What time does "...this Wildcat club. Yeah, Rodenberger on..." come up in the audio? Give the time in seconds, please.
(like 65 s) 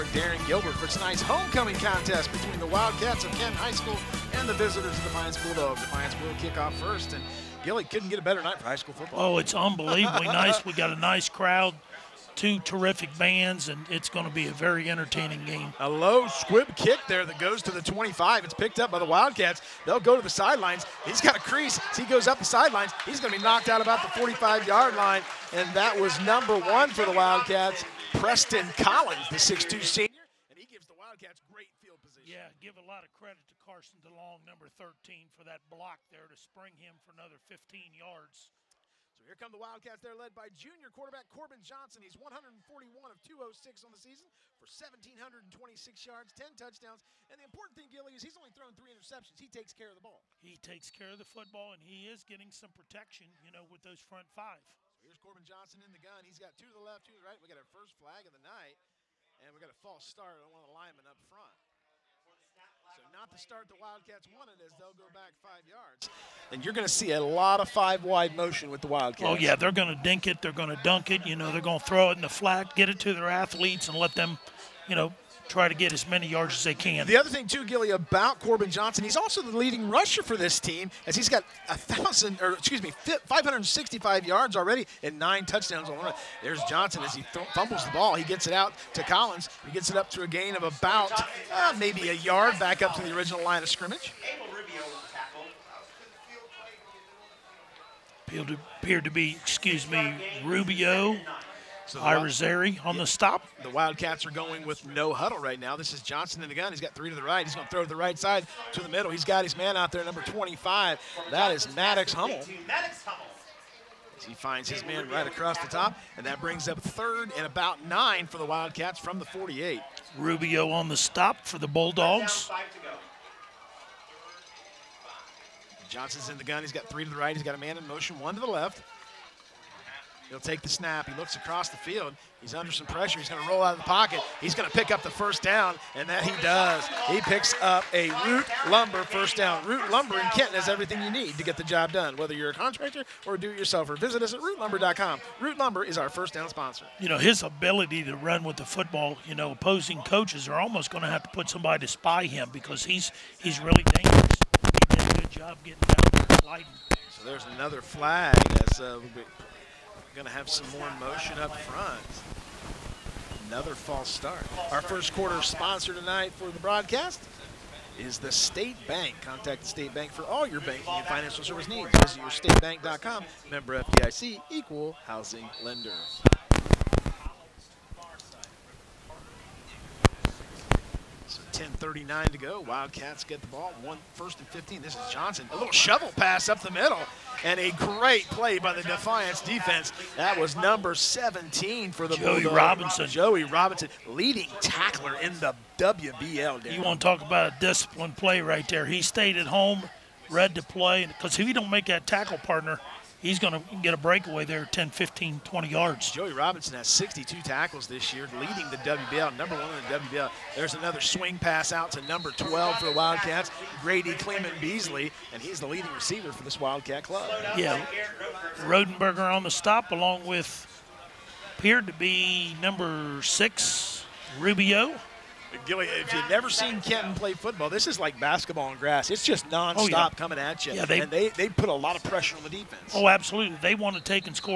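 216 s.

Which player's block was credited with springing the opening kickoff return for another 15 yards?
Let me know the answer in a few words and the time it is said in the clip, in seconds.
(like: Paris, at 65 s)
Carson DeLong, at 33 s.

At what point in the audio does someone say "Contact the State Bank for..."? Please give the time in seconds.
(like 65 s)
169 s.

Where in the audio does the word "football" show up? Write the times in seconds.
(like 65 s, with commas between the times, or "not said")
8 s, 51 s, 148 s, 227 s.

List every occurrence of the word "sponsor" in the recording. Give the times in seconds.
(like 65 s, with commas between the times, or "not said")
146 s, 165 s.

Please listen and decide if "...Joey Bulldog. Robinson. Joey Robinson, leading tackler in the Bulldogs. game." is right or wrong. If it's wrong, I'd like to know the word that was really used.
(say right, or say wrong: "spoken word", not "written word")
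wrong: "WBL", not "Bulldogs".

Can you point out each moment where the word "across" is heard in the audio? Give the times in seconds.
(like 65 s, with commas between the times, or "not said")
115 s, 131 s.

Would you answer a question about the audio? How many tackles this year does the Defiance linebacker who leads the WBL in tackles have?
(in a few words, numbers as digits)
62.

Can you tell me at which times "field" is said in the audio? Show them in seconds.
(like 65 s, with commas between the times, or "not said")
31 s, 131 s.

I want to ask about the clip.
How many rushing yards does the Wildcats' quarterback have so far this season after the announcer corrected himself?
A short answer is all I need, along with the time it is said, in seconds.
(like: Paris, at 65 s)
565, at 83 s.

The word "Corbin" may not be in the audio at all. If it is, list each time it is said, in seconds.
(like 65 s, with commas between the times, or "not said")
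41 s, 55 s, 78 s.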